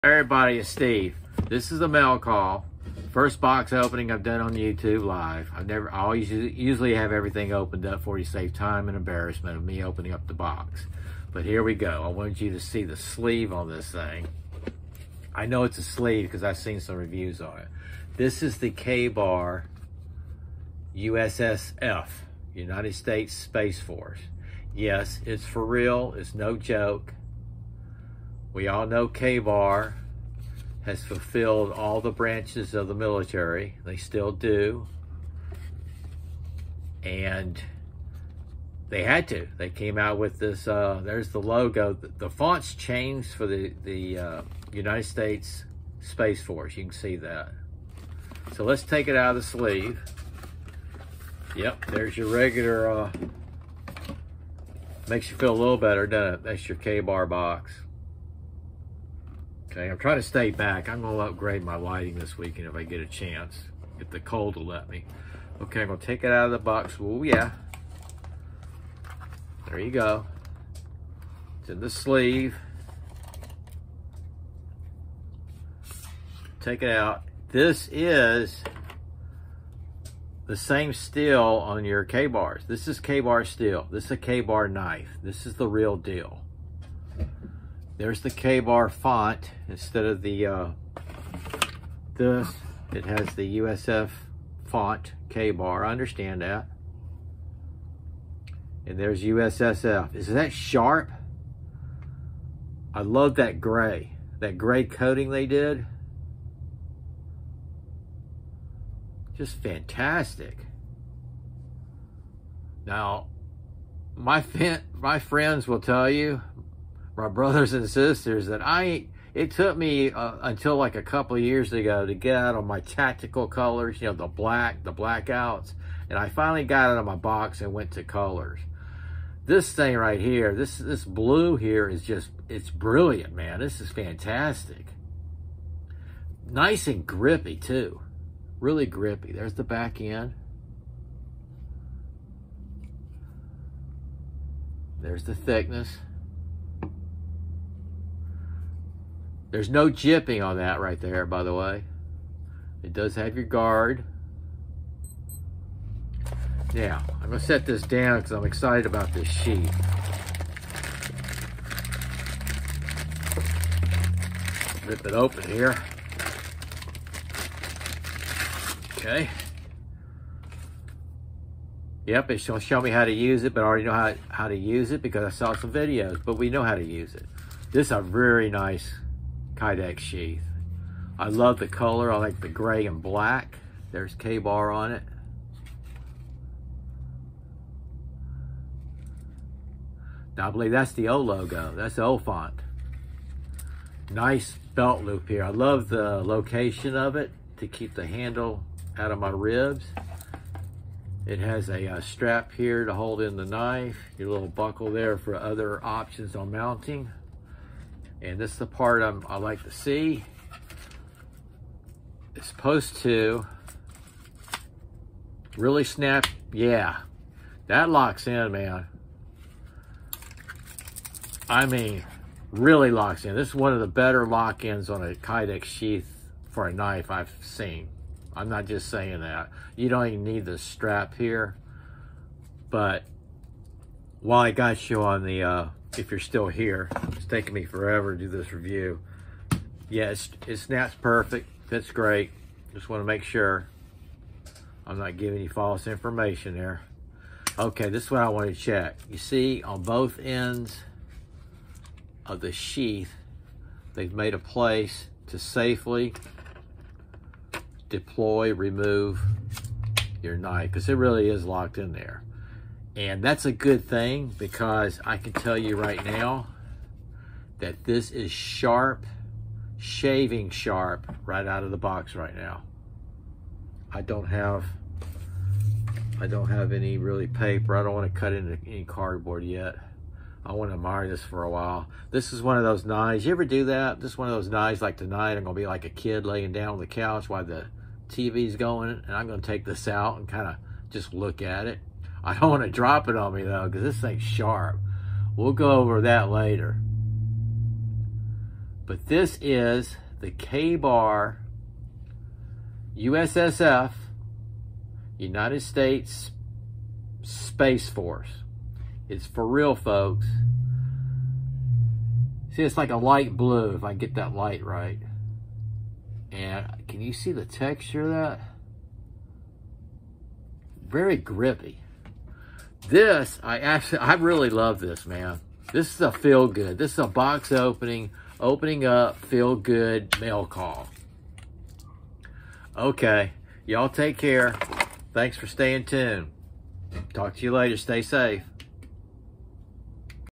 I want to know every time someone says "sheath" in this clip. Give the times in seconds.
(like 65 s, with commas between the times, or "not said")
179 s, 225 s, 252 s.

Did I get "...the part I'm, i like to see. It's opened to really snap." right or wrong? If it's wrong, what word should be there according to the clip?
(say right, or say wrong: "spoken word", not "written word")
wrong: "supposed", not "opened".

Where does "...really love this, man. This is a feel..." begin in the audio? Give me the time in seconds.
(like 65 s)
324 s.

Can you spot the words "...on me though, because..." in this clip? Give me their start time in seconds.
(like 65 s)
293 s.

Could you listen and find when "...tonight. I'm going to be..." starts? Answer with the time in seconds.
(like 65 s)
284 s.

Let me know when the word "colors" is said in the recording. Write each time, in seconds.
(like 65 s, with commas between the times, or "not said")
123 s, 128 s, 181 s.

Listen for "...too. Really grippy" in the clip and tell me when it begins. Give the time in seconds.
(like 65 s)
137 s.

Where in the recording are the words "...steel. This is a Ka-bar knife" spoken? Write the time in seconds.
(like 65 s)
83 s.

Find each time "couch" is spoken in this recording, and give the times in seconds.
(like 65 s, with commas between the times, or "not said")
286 s.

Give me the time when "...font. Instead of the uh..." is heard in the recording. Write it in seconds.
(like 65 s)
88 s.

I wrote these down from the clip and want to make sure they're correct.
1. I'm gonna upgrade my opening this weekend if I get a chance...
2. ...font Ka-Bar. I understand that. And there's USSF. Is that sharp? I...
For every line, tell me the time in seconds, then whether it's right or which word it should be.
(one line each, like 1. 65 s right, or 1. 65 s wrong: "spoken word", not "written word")
1. 60 s wrong: "lighting", not "opening"
2. 94 s right.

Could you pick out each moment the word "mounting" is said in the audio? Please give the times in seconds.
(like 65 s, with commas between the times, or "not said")
206 s.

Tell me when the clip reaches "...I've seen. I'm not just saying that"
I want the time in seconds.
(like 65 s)
227 s.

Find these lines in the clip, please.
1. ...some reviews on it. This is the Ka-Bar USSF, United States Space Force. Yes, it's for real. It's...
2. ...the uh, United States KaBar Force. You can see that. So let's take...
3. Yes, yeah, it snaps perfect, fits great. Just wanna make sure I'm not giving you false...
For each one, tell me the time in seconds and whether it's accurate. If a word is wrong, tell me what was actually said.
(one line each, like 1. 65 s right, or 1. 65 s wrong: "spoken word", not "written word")
1. 16 s right
2. 43 s wrong: "Space", not "KaBar"
3. 239 s right.